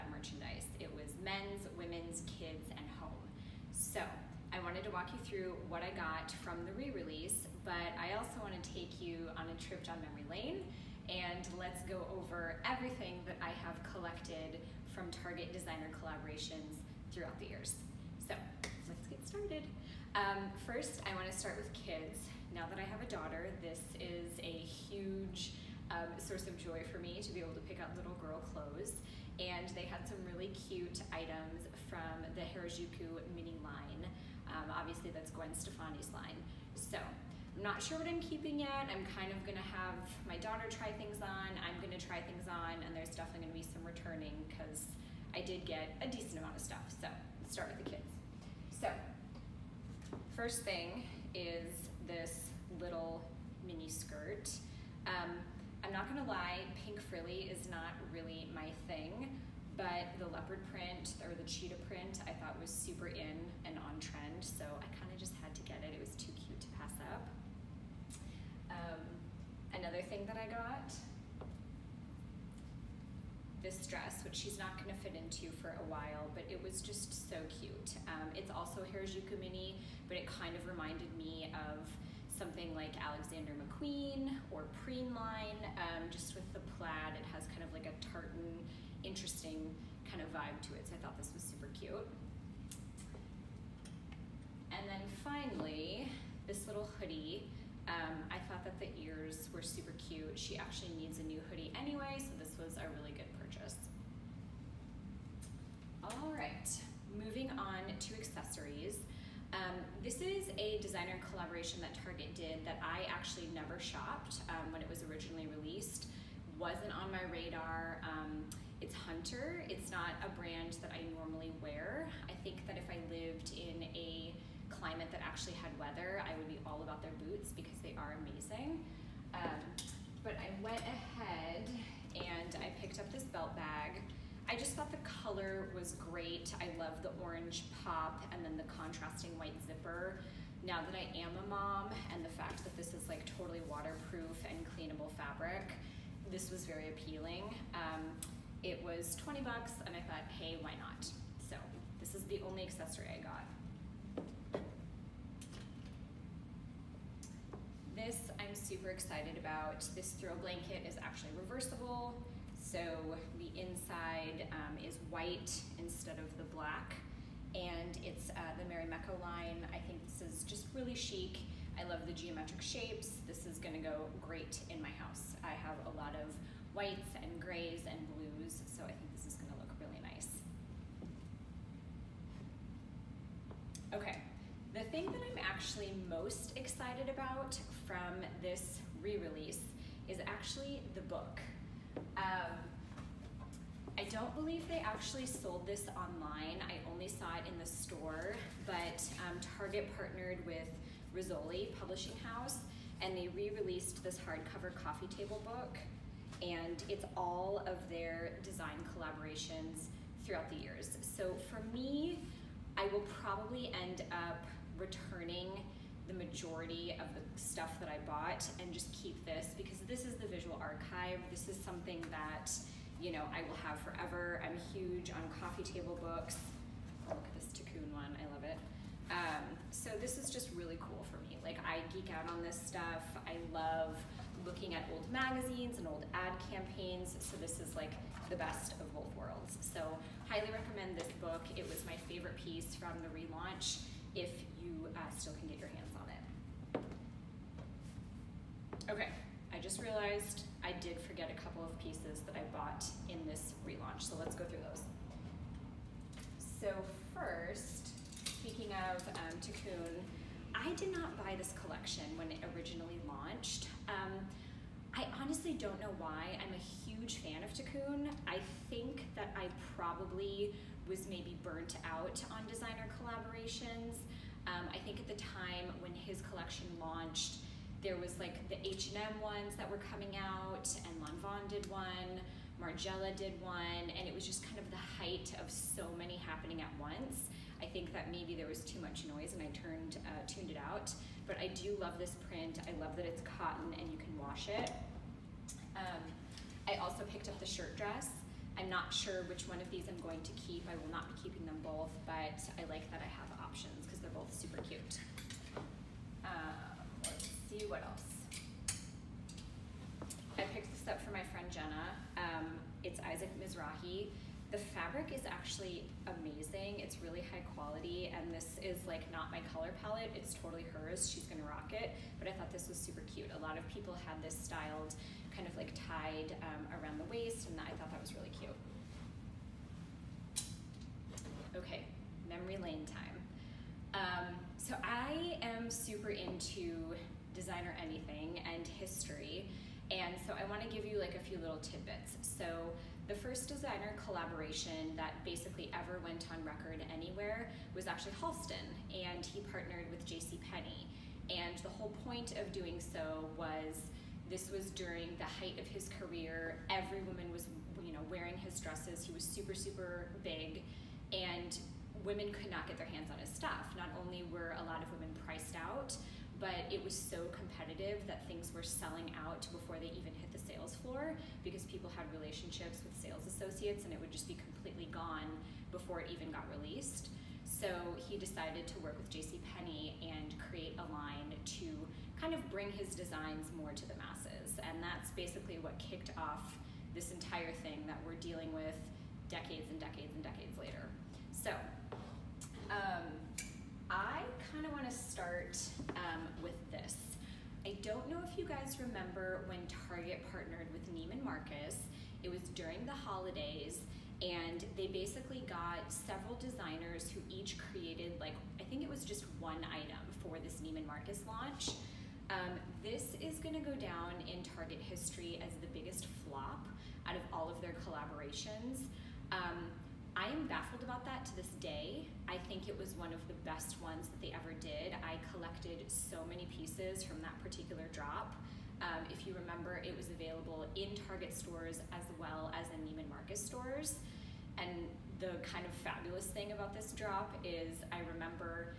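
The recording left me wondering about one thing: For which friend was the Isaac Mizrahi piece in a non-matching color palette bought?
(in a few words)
Jenna.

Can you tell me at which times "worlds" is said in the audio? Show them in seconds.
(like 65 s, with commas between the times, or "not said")
239 s.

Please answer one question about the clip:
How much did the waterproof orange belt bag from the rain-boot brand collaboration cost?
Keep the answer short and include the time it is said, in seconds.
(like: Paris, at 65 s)
$20, at 149 s.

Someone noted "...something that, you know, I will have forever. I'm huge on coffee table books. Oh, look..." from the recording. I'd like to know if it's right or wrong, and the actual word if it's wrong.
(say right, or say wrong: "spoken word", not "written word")
right.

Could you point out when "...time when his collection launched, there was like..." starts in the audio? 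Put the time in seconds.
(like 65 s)
275 s.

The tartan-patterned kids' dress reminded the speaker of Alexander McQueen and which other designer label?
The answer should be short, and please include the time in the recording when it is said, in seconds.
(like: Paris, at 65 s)
Preen, at 84 s.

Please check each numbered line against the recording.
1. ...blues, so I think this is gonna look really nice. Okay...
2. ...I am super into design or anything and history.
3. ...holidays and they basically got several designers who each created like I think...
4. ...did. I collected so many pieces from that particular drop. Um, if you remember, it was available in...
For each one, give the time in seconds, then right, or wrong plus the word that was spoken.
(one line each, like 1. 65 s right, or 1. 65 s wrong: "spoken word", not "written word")
1. 178 s right
2. 334 s right
3. 402 s right
4. 424 s right.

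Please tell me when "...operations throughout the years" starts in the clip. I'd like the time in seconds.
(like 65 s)
209 s.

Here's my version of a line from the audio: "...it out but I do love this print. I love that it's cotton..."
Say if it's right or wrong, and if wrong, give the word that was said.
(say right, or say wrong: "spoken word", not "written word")
right.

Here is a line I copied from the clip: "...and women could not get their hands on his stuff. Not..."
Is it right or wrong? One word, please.
right.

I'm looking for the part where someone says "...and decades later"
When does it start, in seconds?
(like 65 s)
390 s.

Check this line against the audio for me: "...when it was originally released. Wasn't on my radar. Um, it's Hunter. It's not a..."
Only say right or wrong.
right.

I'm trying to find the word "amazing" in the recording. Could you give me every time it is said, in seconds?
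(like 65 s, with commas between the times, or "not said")
128 s, 316 s.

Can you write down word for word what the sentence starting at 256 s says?
So first, speaking of um, I did not buy this collection when it originally launched.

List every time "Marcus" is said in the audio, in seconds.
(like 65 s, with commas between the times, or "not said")
401 s, 410 s, 433 s.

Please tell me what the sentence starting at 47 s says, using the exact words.
So let's start with the kids.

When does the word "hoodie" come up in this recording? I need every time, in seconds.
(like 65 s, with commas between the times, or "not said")
96 s, 101 s.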